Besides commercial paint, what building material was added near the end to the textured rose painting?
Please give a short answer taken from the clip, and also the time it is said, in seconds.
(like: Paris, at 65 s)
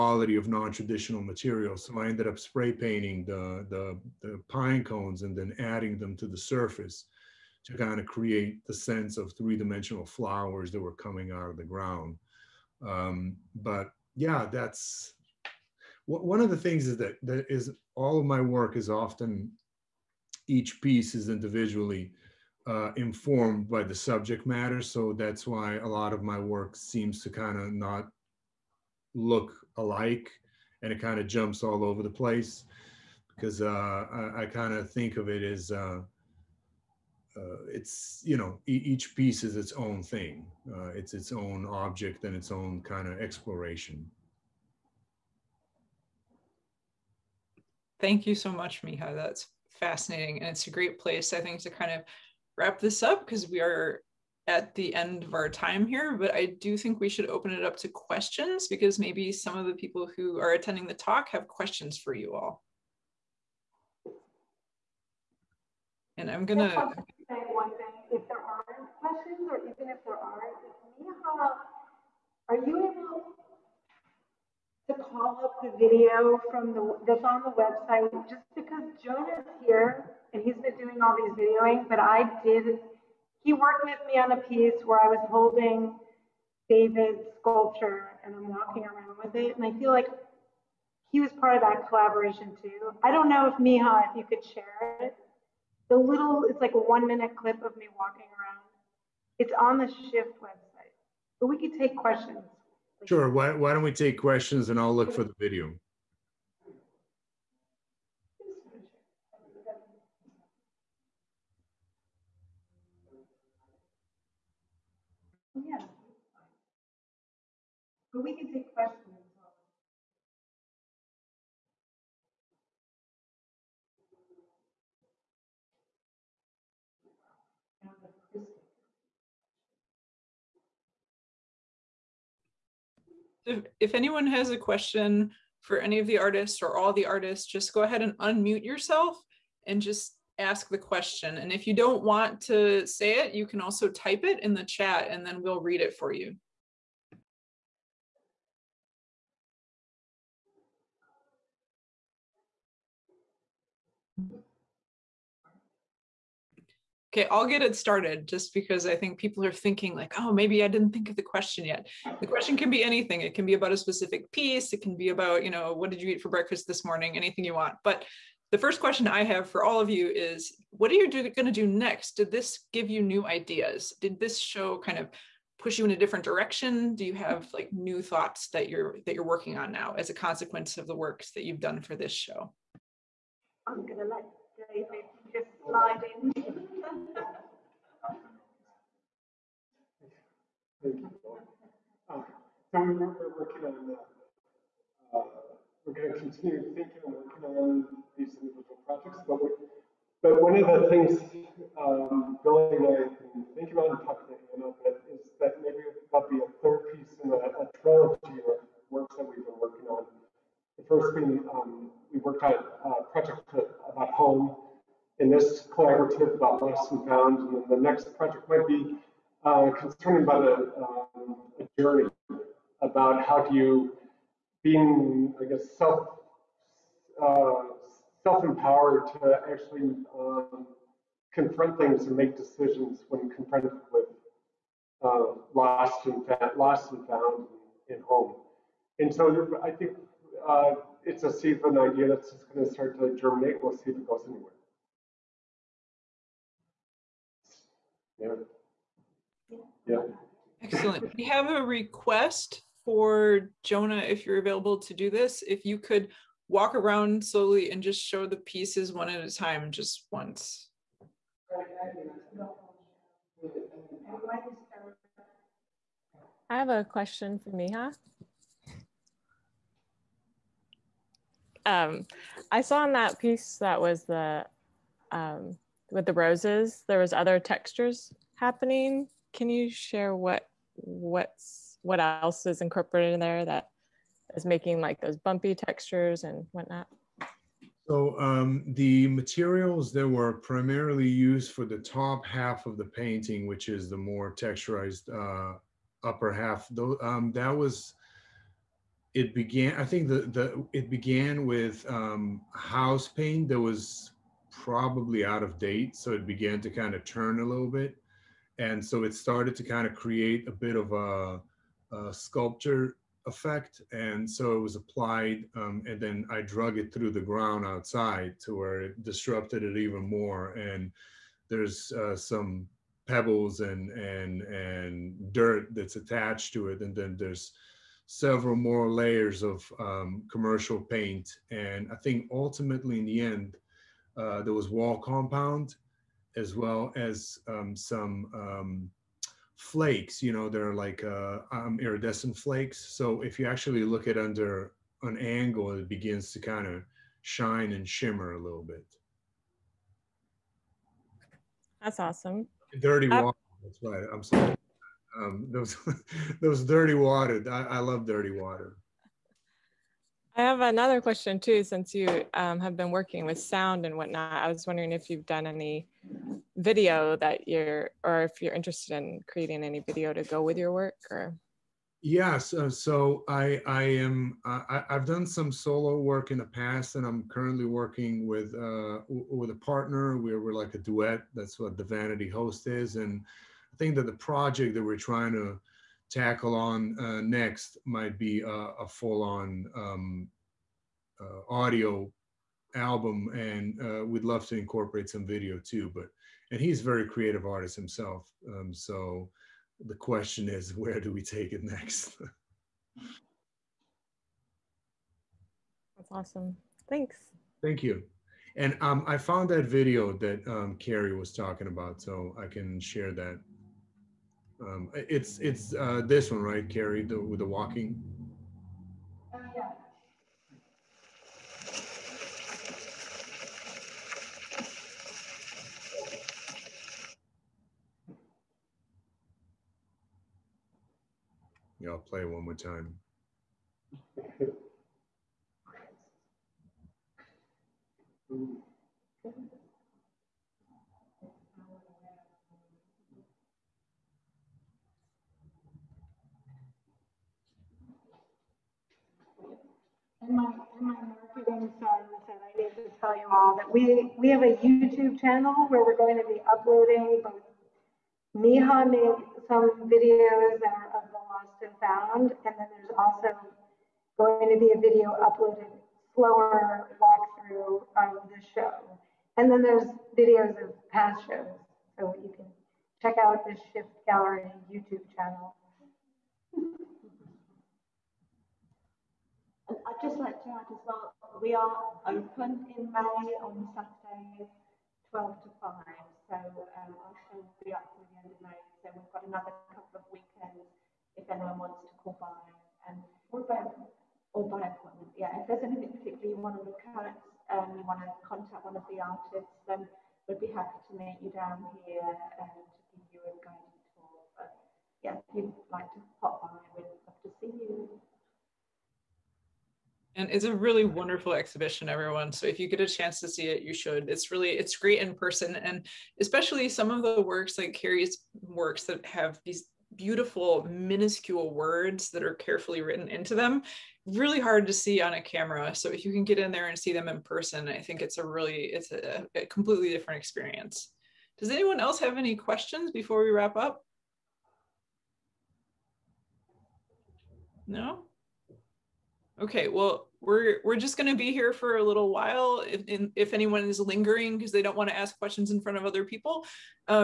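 Wall compound, at 334 s.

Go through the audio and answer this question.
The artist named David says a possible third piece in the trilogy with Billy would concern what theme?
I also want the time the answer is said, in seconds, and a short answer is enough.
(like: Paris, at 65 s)
A journey, at 220 s.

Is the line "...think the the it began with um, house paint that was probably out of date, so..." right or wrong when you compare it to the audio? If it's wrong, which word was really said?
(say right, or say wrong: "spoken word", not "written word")
right.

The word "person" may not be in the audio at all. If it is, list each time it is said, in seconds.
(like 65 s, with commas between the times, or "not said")
515 s, 527 s.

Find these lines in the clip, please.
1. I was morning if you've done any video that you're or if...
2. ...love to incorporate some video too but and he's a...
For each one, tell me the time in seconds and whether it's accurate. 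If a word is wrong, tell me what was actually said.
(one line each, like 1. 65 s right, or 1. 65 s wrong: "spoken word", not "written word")
1. 364 s wrong: "wondering", not "morning"
2. 394 s right.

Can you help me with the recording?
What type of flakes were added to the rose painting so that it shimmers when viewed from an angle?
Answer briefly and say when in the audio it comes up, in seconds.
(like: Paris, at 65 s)
Iridescent flakes, at 341 s.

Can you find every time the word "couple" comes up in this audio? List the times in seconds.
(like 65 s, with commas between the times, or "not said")
489 s.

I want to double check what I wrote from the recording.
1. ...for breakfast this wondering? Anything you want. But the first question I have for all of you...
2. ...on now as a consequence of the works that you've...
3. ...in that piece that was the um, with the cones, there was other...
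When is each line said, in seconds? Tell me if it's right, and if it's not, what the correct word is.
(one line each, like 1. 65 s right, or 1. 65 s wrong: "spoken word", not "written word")
1. 166 s wrong: "morning", not "wondering"
2. 179 s right
3. 272 s wrong: "roses", not "cones".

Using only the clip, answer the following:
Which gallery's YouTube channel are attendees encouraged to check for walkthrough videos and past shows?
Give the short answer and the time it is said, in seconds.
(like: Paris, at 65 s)
Shift Gallery, at 473 s.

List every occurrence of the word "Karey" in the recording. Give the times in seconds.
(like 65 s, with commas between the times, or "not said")
410 s, 416 s, 517 s.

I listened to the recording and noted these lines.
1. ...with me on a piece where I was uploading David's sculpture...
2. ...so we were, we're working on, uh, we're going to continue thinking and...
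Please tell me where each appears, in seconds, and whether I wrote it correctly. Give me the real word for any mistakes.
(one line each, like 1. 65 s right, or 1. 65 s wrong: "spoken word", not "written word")
1. 83 s wrong: "holding", not "uploading"
2. 192 s right.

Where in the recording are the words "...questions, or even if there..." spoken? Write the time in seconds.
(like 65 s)
68 s.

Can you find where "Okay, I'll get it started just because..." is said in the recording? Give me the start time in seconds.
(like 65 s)
157 s.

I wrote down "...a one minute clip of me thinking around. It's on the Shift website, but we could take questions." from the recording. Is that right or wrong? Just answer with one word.
wrong.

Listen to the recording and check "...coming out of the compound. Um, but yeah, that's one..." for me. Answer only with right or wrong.
wrong.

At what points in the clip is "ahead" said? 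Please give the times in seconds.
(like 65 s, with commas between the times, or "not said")
137 s.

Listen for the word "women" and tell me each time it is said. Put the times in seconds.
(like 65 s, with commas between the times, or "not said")
not said.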